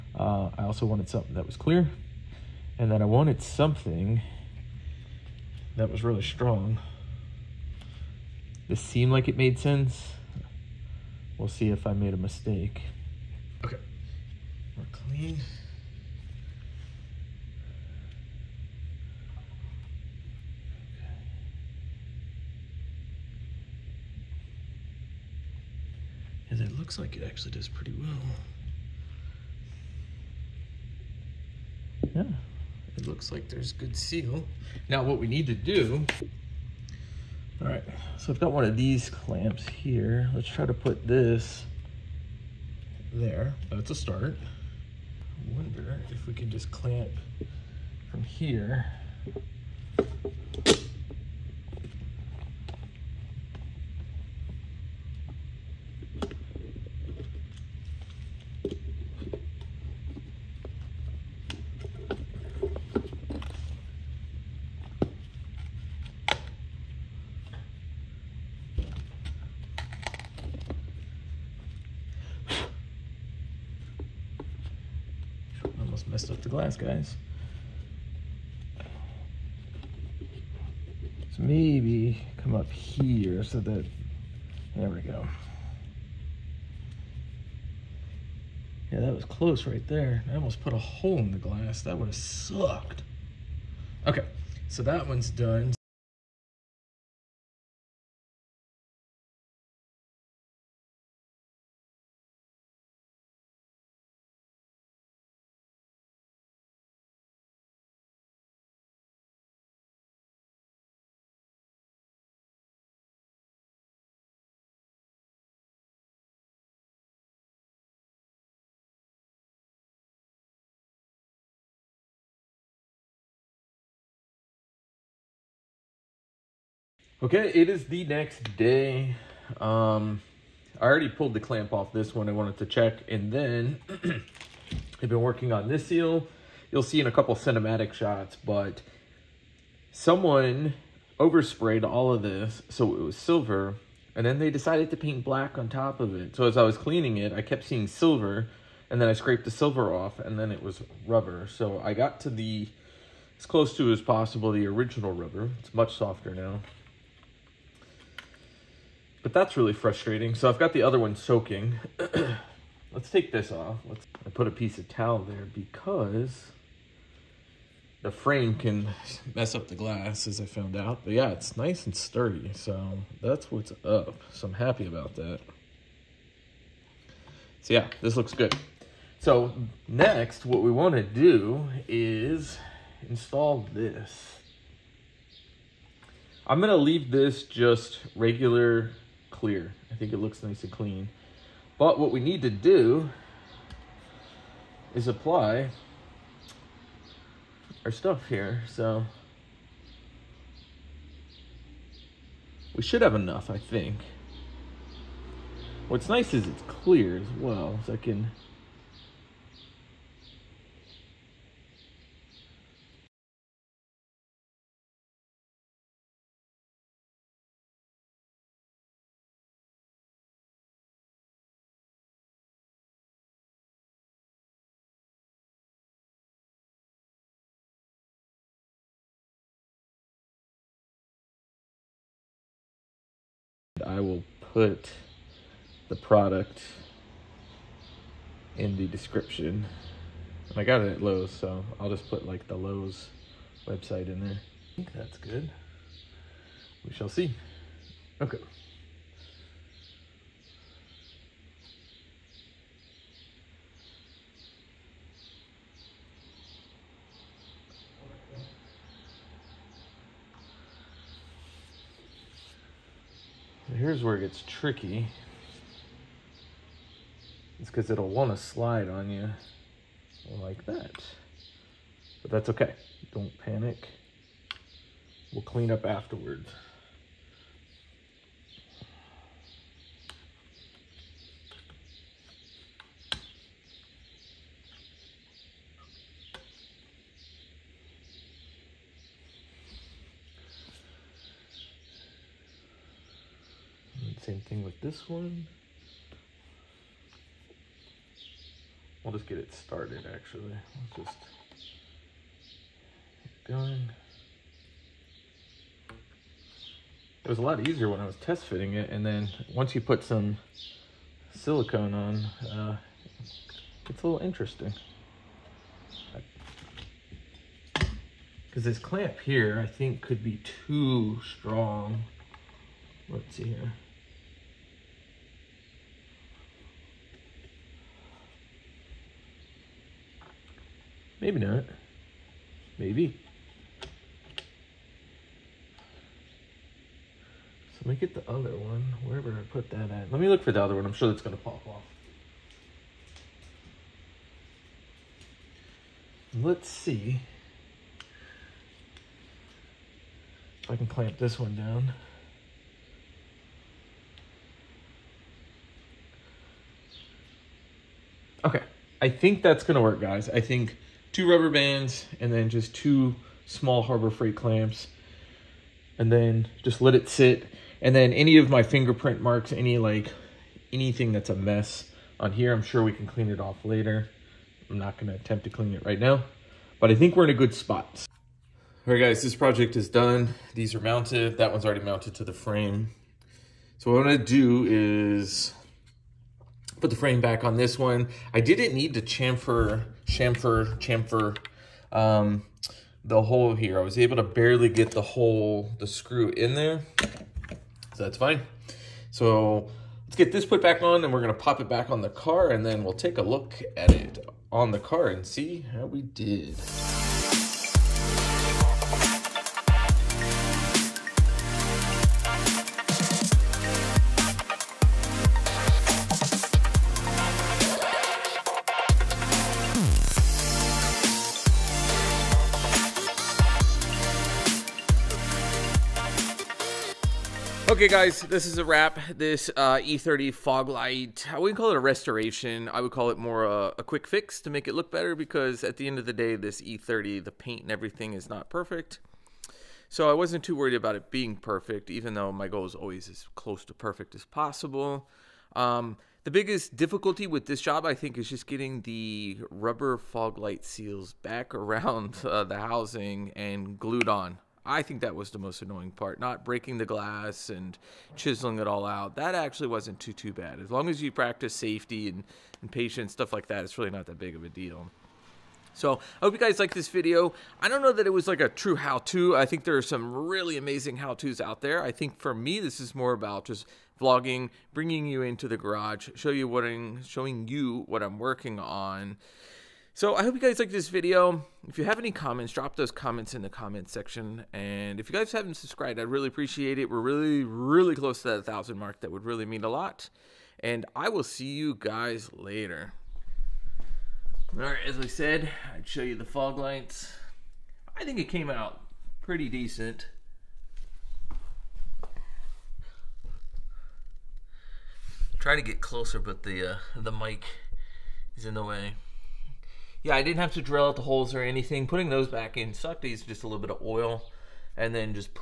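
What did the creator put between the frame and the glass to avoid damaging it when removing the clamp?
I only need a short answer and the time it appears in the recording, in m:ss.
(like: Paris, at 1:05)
A piece of towel, at 2:44.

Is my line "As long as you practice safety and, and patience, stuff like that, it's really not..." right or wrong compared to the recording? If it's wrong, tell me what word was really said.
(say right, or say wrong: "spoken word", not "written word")
right.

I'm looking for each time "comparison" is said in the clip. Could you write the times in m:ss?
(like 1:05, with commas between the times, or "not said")
not said.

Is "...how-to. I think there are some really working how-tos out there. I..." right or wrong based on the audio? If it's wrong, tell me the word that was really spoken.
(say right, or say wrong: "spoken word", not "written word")
wrong: "amazing", not "working".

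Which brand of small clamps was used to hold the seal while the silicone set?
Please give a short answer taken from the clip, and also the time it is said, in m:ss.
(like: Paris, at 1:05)
Harbor Freight, at 6:02.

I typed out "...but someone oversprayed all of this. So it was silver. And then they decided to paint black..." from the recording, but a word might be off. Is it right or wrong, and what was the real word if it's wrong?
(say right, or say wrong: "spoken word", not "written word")
right.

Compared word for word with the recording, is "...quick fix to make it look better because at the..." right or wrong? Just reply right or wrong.
right.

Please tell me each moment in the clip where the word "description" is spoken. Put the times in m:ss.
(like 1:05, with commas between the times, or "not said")
3:58.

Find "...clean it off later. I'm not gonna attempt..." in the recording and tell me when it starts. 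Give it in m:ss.
6:13.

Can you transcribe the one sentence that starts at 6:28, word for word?
I didn't need to chamfer chamfer, chamfer, um, the hole here.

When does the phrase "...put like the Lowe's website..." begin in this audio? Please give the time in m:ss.
4:02.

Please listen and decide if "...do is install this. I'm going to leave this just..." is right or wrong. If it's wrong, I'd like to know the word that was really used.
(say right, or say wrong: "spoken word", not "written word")
right.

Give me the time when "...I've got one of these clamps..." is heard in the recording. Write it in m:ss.
0:38.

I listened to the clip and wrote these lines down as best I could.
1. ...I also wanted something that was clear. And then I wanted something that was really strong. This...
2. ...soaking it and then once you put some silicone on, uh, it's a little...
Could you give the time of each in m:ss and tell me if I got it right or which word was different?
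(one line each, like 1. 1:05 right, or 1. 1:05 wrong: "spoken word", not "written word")
1. 0:00 right
2. 5:08 wrong: "fitting", not "soaking".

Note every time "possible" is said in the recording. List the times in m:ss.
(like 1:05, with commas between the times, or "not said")
2:34, 7:24.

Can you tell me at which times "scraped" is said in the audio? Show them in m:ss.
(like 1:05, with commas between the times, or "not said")
2:29.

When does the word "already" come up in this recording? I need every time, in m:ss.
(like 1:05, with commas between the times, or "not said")
2:10, 6:21.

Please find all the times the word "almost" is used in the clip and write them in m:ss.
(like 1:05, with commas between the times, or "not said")
1:16, 1:30.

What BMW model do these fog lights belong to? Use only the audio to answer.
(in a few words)
E30.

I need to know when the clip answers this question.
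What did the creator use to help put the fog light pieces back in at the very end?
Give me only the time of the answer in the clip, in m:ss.
8:33.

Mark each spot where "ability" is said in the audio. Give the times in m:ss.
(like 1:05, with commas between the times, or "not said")
not said.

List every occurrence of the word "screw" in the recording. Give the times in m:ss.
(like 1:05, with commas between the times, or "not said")
6:35.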